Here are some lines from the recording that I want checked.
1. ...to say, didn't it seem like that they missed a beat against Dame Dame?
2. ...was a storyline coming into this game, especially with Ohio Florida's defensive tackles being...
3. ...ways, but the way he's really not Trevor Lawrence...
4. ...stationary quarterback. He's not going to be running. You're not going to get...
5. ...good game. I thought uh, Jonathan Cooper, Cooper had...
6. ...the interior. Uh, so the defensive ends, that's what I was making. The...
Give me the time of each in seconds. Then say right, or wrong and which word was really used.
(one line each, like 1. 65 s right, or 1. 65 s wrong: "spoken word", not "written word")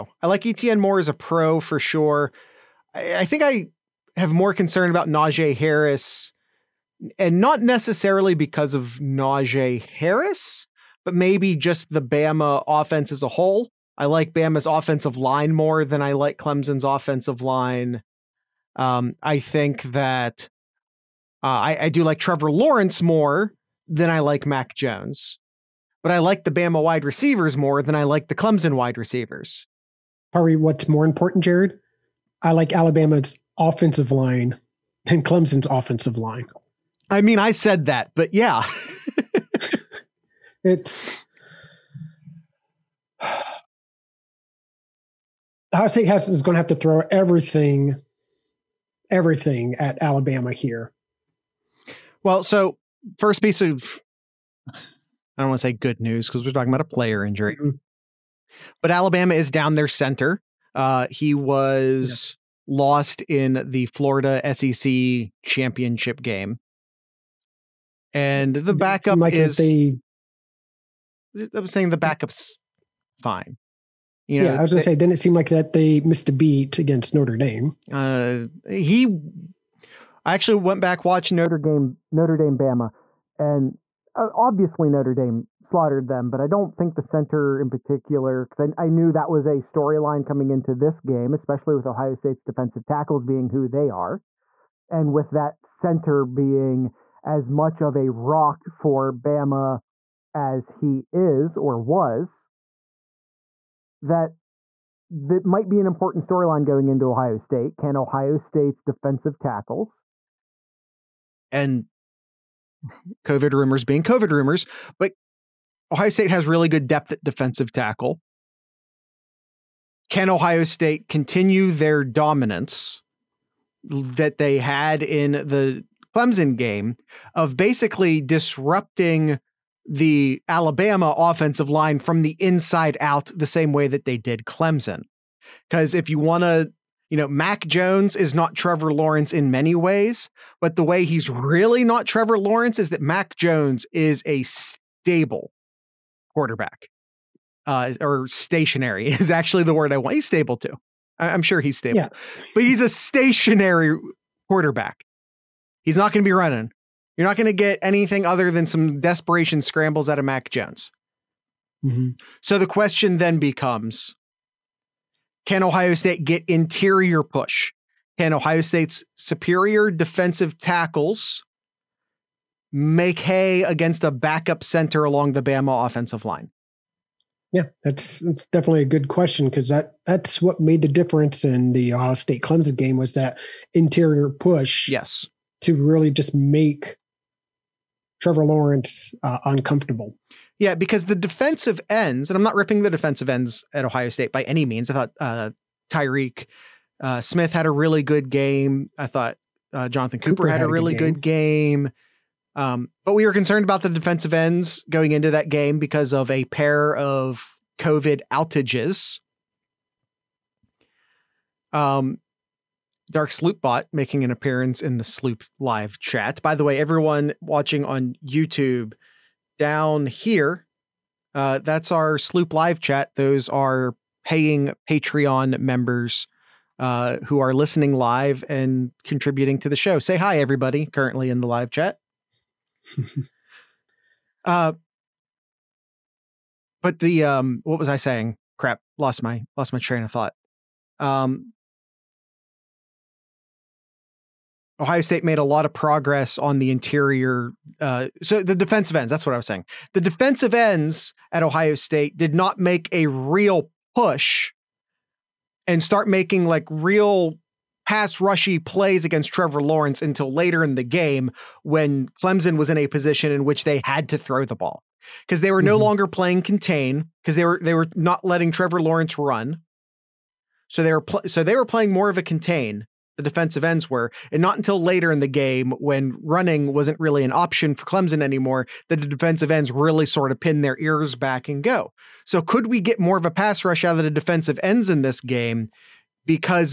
1. 74 s wrong: "Notre", not "Dame"
2. 89 s wrong: "State", not "Florida"
3. 139 s right
4. 152 s right
5. 198 s right
6. 246 s wrong: "saying", not "making".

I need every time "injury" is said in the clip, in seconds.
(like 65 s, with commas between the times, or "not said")
57 s.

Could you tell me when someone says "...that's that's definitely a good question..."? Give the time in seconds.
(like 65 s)
177 s.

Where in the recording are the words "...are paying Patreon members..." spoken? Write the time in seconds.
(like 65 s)
223 s.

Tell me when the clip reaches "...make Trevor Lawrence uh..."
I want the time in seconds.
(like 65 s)
186 s.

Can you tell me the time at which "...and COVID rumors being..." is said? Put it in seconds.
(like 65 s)
111 s.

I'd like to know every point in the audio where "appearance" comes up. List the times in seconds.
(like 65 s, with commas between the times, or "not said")
214 s.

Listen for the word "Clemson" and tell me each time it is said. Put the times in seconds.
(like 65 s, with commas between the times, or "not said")
16 s, 28 s, 35 s, 126 s, 134 s, 182 s, 262 s, 277 s.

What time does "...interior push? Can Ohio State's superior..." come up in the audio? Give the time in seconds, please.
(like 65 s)
166 s.